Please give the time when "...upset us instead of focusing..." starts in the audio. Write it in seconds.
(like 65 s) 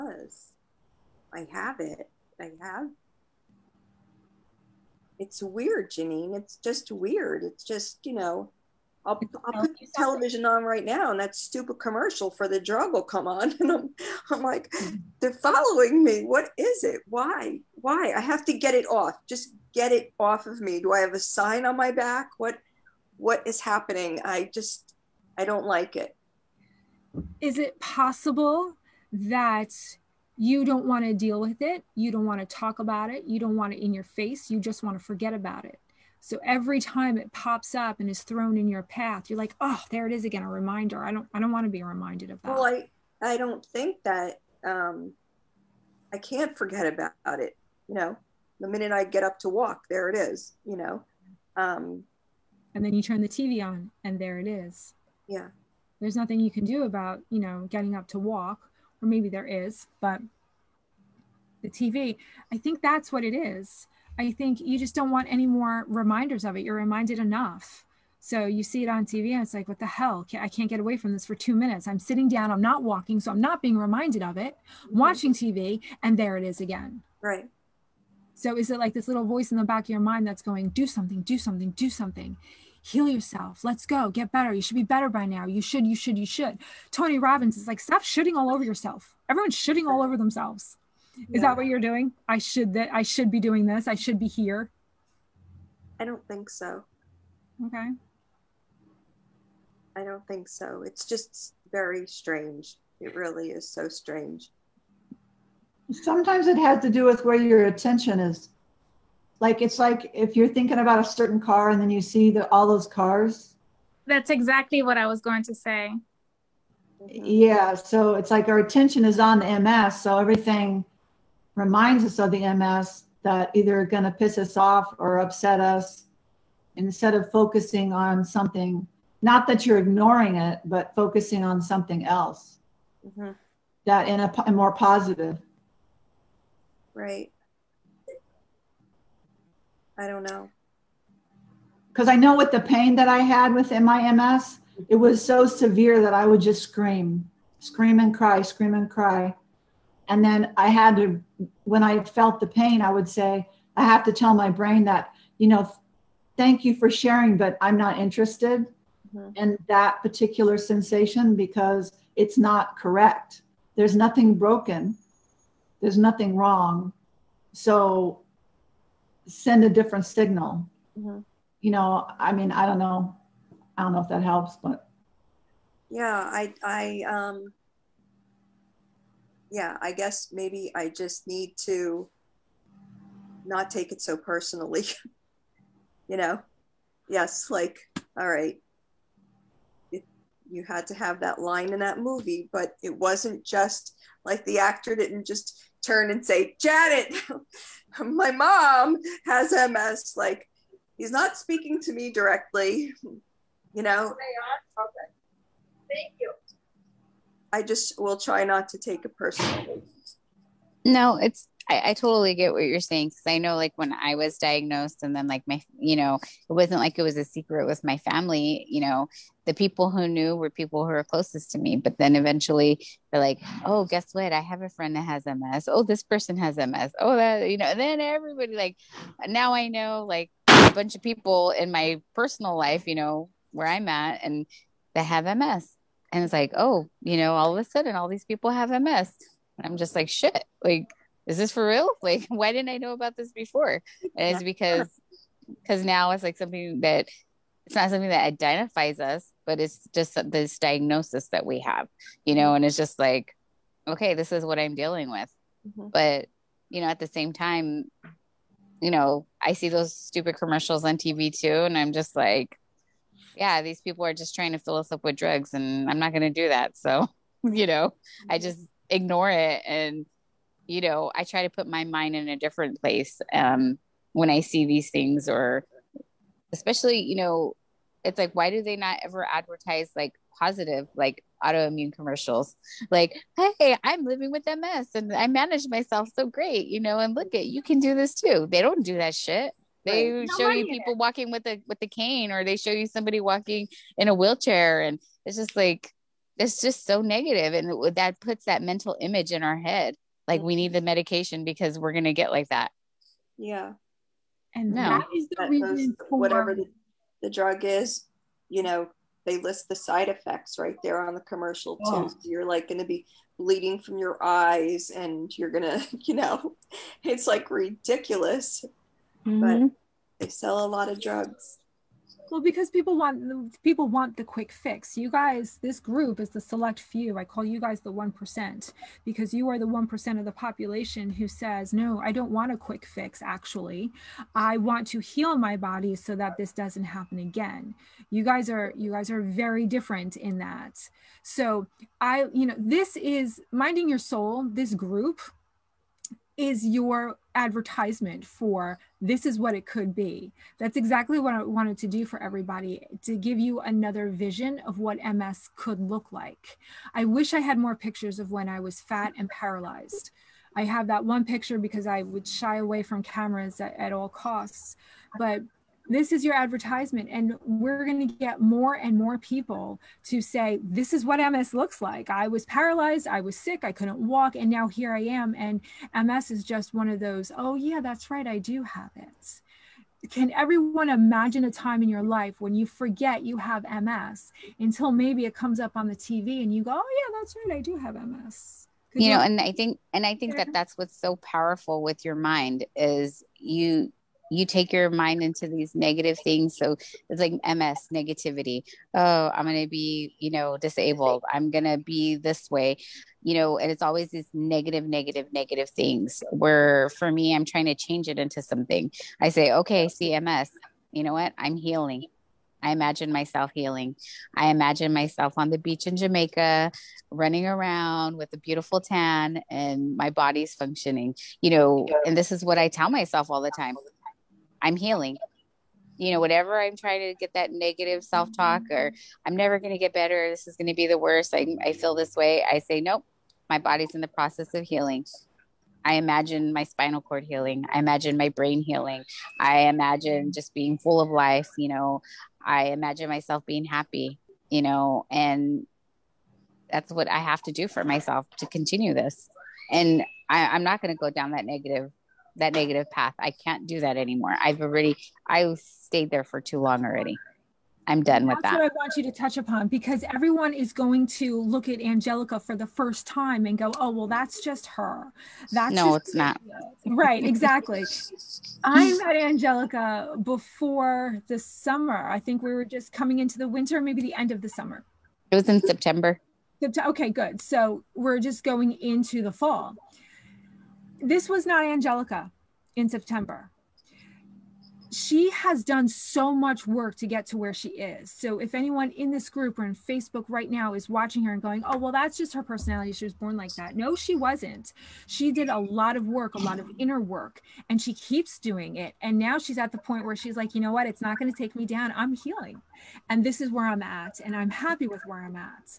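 125 s.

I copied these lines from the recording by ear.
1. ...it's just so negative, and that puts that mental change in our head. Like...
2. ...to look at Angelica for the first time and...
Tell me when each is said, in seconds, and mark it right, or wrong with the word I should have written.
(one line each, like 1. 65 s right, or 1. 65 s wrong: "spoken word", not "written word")
1. 296 s wrong: "image", not "change"
2. 461 s right.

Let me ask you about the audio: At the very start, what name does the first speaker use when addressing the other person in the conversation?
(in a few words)
Janine.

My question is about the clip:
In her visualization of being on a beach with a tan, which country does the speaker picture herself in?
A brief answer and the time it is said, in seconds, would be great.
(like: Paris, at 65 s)
Jamaica, at 415 s.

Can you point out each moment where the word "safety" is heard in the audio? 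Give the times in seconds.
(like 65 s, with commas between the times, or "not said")
not said.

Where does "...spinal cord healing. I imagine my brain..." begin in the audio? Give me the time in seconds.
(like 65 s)
436 s.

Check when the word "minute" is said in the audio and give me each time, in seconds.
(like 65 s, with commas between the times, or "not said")
48 s, 71 s.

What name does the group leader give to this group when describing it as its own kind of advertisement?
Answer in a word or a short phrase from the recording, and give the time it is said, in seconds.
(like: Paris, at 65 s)
Minding Your Soul, at 343 s.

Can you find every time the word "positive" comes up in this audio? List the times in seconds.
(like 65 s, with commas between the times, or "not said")
134 s, 280 s.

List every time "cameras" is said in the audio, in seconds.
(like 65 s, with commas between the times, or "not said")
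363 s.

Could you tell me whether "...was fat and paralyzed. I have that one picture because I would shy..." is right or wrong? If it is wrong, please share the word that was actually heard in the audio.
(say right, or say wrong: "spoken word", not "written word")
right.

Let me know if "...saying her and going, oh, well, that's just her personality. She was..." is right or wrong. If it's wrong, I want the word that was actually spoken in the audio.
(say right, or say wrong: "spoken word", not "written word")
wrong: "watching", not "saying".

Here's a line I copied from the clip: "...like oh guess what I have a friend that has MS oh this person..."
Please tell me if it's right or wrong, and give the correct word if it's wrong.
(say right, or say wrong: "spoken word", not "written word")
right.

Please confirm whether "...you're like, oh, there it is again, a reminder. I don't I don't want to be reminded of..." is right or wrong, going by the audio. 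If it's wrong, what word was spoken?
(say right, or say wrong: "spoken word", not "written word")
right.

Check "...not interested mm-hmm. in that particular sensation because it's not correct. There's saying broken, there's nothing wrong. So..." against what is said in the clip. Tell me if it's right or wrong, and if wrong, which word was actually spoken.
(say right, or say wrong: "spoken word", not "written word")
wrong: "nothing", not "saying".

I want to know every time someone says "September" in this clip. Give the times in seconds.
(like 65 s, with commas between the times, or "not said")
475 s, 482 s.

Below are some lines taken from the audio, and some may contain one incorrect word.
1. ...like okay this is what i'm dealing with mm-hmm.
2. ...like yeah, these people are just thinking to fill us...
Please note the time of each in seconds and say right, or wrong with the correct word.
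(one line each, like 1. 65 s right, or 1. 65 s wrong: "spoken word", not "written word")
1. 252 s right
2. 262 s wrong: "trying", not "thinking".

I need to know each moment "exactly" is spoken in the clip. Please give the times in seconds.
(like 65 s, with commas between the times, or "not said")
114 s, 350 s, 467 s.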